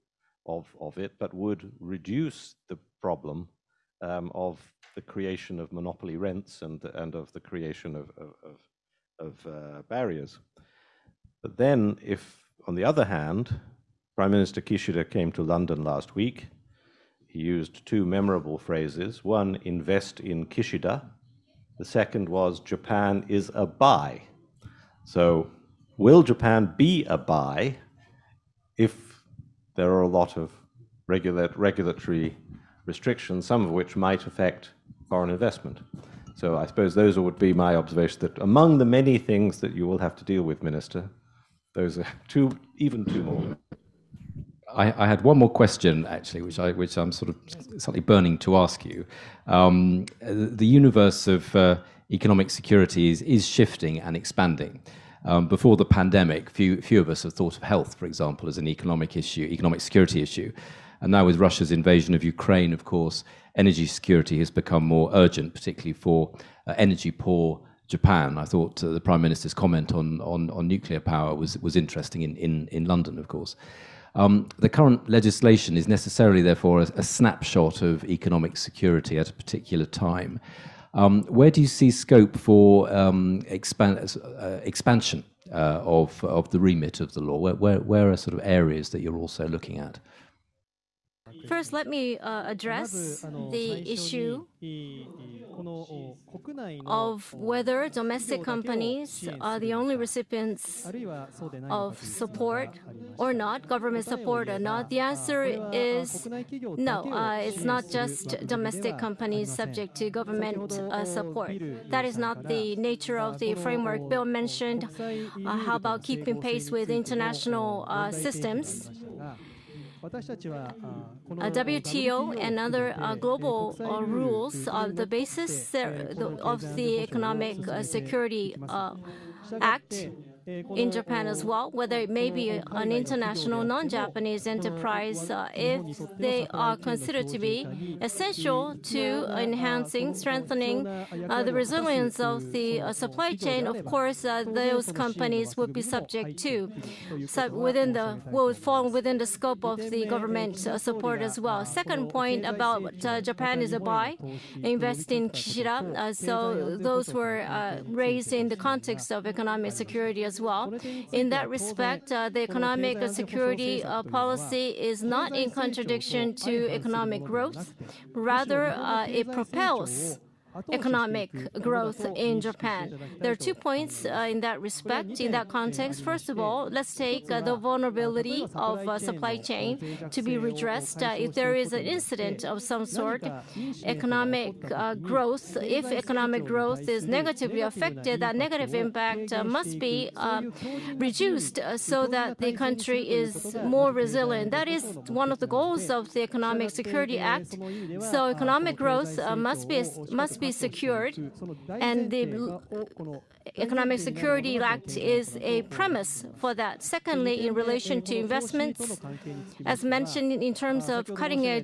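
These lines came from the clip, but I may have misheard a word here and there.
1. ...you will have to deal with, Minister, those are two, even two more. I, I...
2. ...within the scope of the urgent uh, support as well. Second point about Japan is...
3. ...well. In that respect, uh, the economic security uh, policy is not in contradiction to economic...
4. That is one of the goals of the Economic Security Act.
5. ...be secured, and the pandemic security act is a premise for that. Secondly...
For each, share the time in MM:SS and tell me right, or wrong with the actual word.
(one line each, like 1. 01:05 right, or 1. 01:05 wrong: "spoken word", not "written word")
1. 00:39 right
2. 02:28 wrong: "government", not "urgent"
3. 02:40 right
4. 03:14 right
5. 03:20 wrong: "economic", not "pandemic".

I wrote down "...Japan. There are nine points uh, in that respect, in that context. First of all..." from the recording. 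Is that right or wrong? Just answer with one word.
wrong.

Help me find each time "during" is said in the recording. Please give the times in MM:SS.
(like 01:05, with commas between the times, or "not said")
not said.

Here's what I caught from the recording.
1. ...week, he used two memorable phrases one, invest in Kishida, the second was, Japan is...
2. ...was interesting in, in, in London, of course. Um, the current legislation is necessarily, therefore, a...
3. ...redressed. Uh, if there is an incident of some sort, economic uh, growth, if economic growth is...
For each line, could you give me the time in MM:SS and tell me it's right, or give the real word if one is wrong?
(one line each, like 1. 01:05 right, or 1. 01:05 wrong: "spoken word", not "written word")
1. 00:16 right
2. 01:11 right
3. 03:00 right.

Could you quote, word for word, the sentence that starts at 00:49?
Um, the universe of uh, economic securities is shifting and expanding.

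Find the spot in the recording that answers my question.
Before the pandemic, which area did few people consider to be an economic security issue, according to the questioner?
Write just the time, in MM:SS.
00:57.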